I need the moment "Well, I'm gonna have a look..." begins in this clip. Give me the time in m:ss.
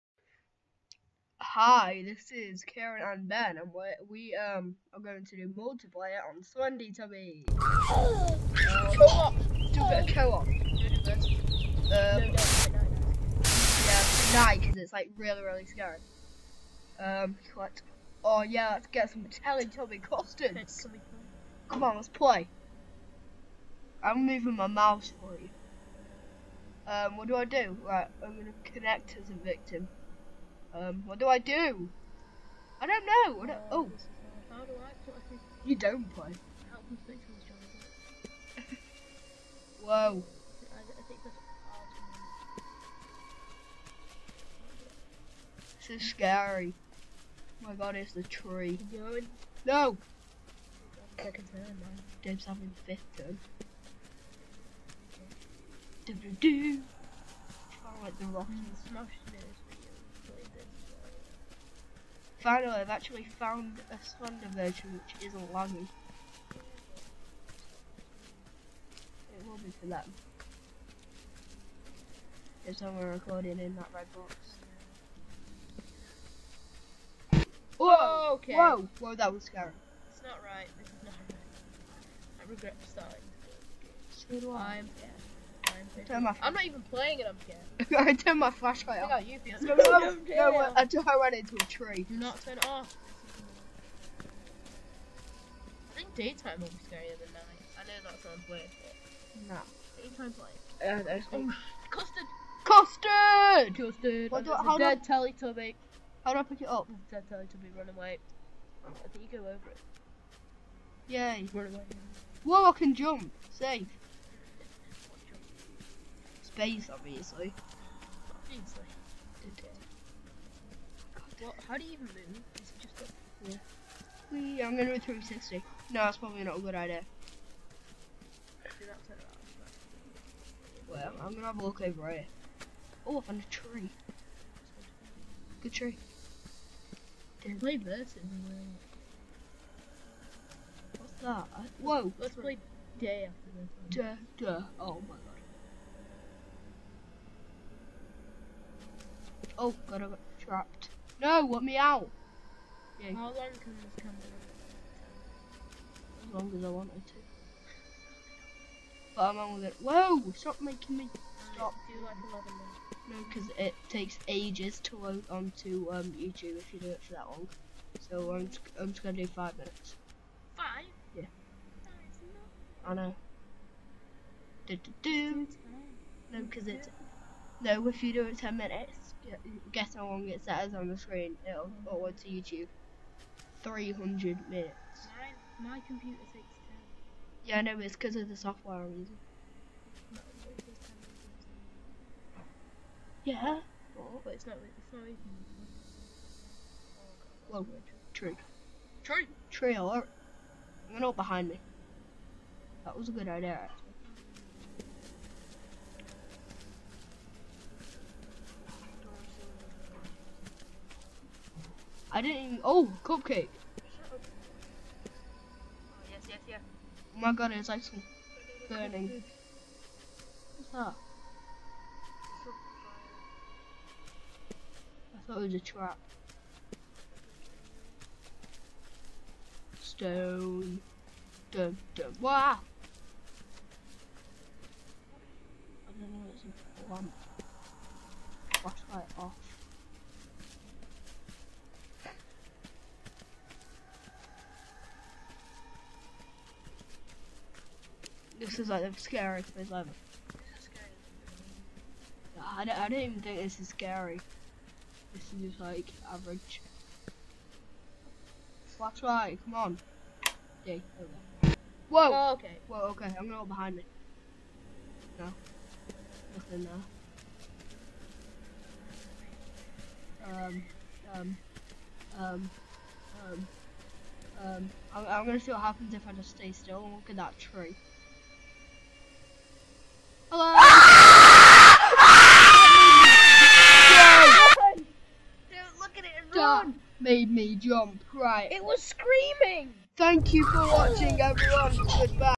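2:10.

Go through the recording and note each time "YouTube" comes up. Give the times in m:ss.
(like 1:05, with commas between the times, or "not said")
2:46, 3:02.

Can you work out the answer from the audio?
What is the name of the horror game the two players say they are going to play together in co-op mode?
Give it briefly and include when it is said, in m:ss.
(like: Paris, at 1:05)
Slendy Tubby, at 0:06.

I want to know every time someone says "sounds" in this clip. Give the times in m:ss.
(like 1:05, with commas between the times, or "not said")
1:38.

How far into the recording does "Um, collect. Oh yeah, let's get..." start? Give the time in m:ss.
0:16.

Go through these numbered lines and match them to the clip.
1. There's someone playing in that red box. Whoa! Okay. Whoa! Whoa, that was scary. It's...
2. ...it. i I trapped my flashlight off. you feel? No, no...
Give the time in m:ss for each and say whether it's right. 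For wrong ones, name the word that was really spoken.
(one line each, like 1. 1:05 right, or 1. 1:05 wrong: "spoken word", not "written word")
1. 1:12 wrong: "recording", not "playing"
2. 1:27 wrong: "turned", not "trapped".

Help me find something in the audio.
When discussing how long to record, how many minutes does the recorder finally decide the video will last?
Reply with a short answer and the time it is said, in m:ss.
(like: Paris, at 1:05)
5, at 2:49.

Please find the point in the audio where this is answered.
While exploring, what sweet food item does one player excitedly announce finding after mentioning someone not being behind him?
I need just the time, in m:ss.
3:33.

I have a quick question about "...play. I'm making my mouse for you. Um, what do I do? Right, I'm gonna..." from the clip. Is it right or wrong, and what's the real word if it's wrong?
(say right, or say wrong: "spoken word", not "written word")
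wrong: "moving", not "making".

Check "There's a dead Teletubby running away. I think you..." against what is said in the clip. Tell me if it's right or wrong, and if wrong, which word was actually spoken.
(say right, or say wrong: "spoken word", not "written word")
right.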